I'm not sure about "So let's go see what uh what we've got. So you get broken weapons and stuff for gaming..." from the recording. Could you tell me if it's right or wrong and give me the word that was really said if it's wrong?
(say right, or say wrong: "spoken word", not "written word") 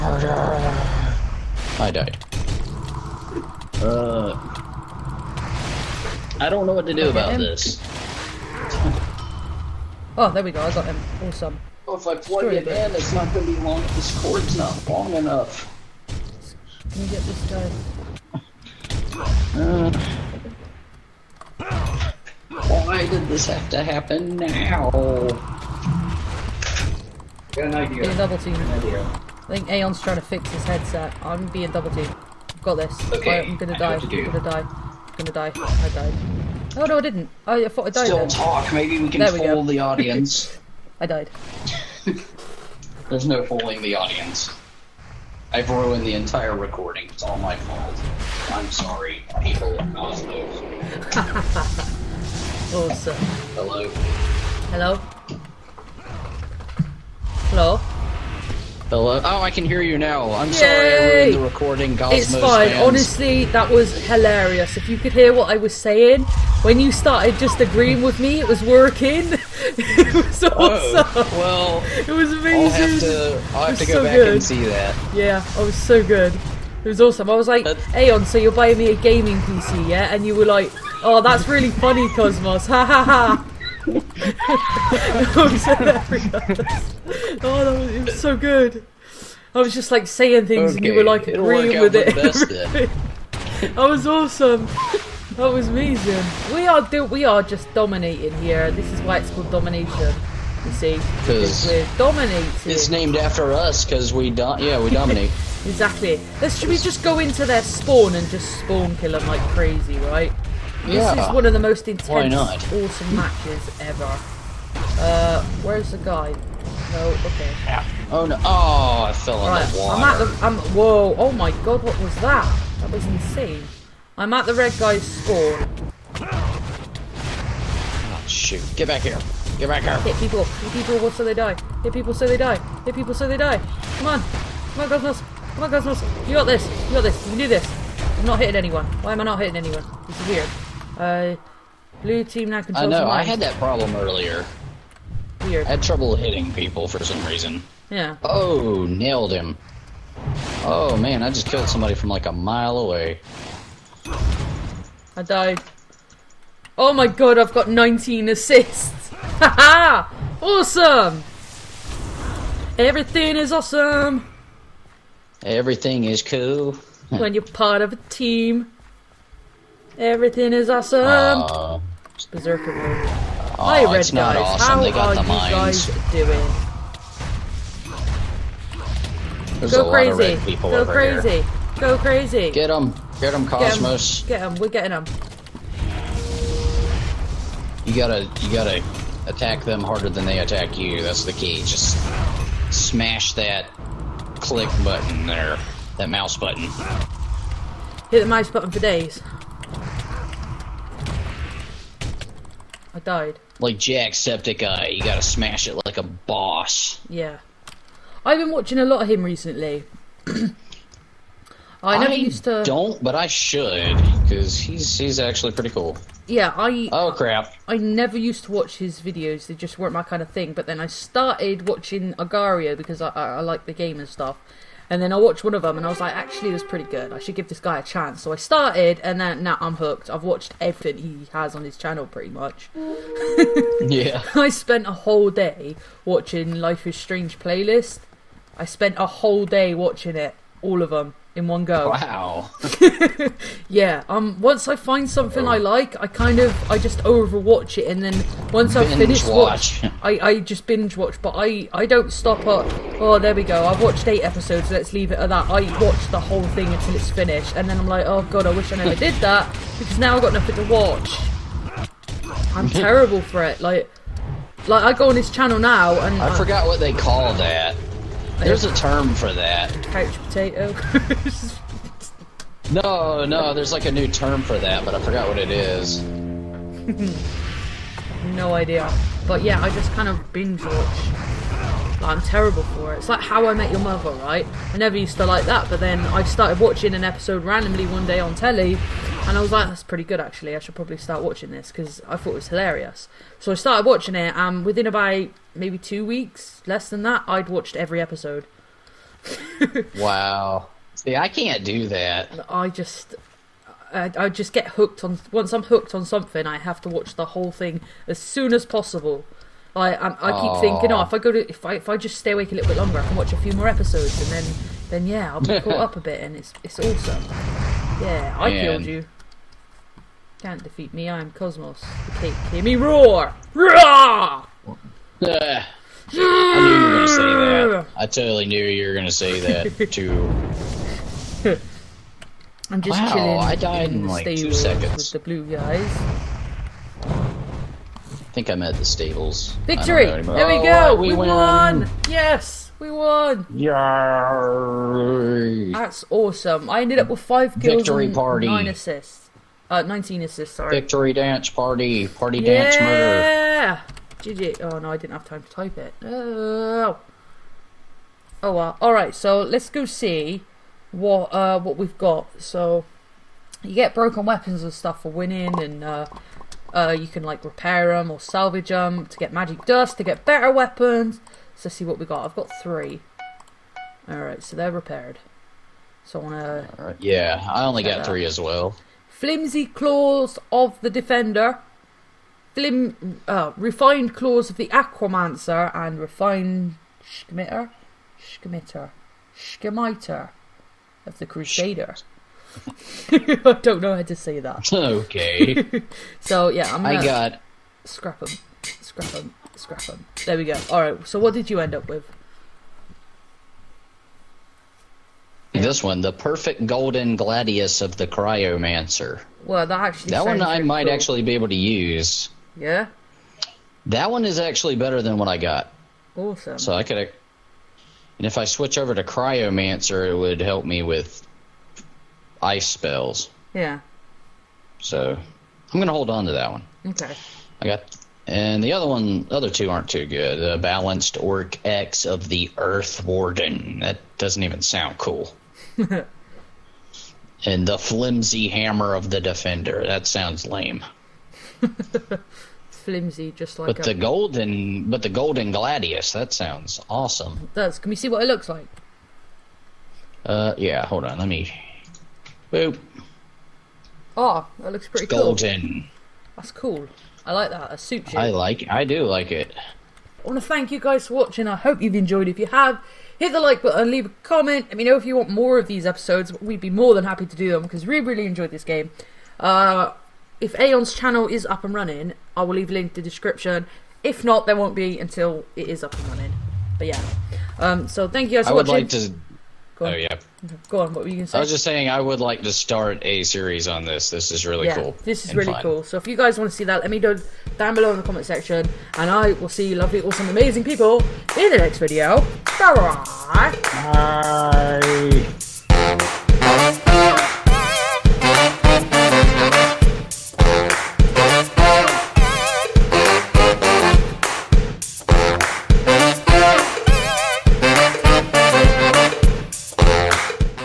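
wrong: "winning", not "gaming".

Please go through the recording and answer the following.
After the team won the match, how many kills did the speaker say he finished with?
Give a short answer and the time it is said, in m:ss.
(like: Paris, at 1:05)
5, at 5:47.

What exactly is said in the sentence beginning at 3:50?
I've watched everything he has on his channel pretty much.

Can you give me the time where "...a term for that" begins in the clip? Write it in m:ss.
4:28.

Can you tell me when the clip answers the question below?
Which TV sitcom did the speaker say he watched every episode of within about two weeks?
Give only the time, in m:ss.
4:43.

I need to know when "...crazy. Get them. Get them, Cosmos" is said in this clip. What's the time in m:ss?
3:01.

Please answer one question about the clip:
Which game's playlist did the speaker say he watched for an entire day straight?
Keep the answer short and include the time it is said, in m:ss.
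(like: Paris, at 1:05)
Life is Strange, at 3:56.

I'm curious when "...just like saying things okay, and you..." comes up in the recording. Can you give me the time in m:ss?
1:29.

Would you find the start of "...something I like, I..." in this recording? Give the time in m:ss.
4:05.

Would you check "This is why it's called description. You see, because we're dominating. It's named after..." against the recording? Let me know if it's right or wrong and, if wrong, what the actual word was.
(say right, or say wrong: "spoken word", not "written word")
wrong: "domination", not "description".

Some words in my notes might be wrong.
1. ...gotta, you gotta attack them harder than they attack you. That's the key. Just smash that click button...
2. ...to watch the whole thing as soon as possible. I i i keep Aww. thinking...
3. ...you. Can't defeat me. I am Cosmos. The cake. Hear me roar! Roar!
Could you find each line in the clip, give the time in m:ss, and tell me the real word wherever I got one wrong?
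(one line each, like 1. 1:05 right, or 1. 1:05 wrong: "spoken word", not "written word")
1. 3:07 right
2. 5:06 right
3. 5:18 right.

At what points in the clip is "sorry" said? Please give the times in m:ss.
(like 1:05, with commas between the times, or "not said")
0:48, 1:00, 5:50.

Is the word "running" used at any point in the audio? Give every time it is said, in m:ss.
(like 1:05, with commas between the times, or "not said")
7:51, 7:56.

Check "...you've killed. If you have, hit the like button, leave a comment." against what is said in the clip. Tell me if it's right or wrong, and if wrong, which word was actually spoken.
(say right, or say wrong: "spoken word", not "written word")
wrong: "enjoyed", not "killed".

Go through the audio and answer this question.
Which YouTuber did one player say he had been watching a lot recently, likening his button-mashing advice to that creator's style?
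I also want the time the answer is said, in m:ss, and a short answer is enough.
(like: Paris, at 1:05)
Jacksepticeye, at 3:24.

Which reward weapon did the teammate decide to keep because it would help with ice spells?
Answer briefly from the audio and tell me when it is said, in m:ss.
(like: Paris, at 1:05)
golden gladius of the cryomancer, at 6:46.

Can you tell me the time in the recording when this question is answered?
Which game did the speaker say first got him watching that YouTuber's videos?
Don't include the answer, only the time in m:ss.
3:42.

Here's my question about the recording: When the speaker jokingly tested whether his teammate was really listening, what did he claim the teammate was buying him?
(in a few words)
a gaming PC.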